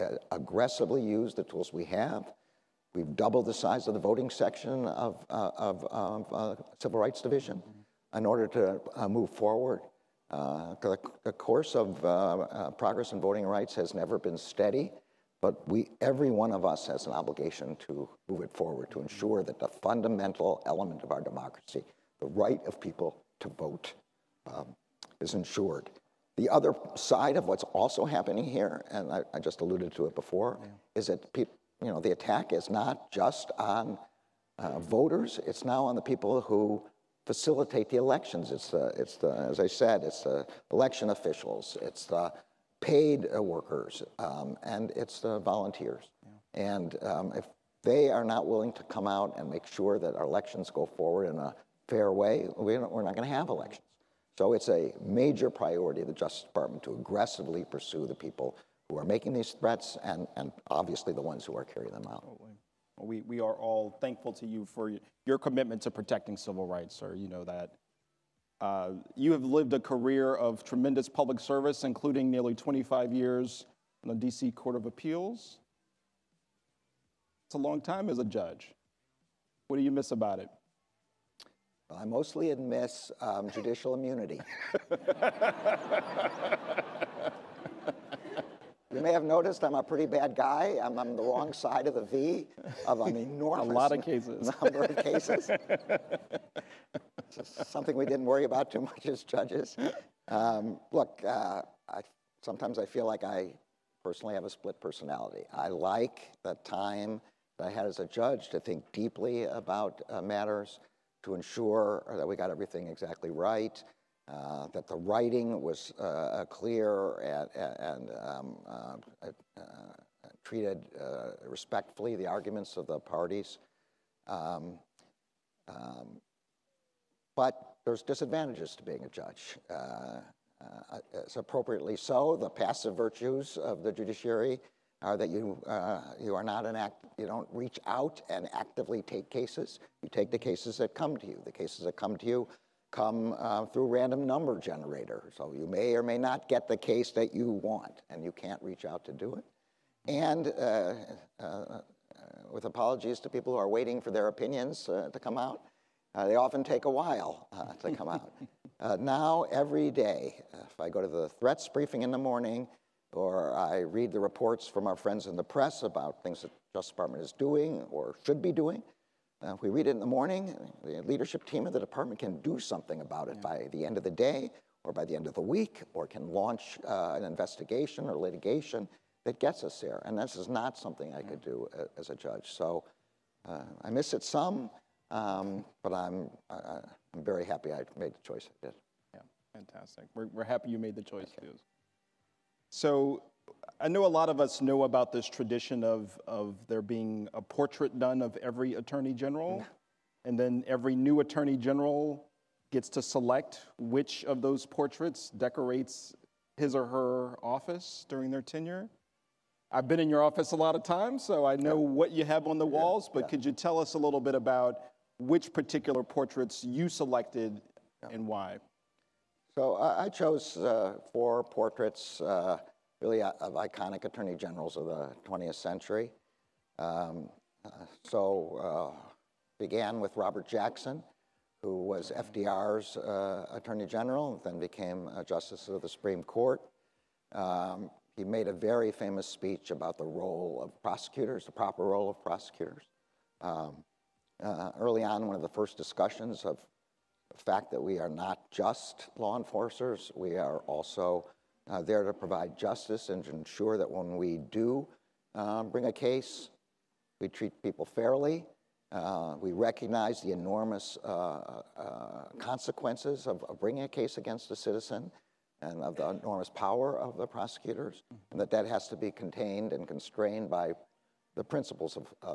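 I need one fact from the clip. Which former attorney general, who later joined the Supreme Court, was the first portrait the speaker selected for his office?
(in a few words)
Robert Jackson.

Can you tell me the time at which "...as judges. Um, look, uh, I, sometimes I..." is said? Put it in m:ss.
1:39.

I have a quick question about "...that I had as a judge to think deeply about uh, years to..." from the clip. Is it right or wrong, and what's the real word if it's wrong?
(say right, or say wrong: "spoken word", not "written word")
wrong: "matters", not "years".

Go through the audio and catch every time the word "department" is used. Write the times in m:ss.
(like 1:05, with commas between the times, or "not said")
0:56, 2:46, 2:51.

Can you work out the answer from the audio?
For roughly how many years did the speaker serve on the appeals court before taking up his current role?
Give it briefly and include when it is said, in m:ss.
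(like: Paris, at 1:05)
25 years, at 1:12.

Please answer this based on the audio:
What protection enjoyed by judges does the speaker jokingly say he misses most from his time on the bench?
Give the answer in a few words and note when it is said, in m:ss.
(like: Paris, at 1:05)
judicial immunity, at 1:23.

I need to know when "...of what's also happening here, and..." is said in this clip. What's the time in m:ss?
0:27.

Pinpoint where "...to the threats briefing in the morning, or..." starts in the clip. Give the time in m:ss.
2:41.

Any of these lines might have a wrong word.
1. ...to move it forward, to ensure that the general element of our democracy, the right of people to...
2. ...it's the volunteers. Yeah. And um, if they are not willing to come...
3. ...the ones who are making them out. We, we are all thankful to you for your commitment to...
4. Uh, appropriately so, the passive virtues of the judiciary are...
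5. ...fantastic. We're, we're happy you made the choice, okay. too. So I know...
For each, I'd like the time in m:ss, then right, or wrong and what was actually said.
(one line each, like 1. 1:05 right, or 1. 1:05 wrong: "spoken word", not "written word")
1. 0:17 wrong: "fundamental", not "general"
2. 0:44 right
3. 1:01 wrong: "carrying", not "making"
4. 2:09 right
5. 3:09 right.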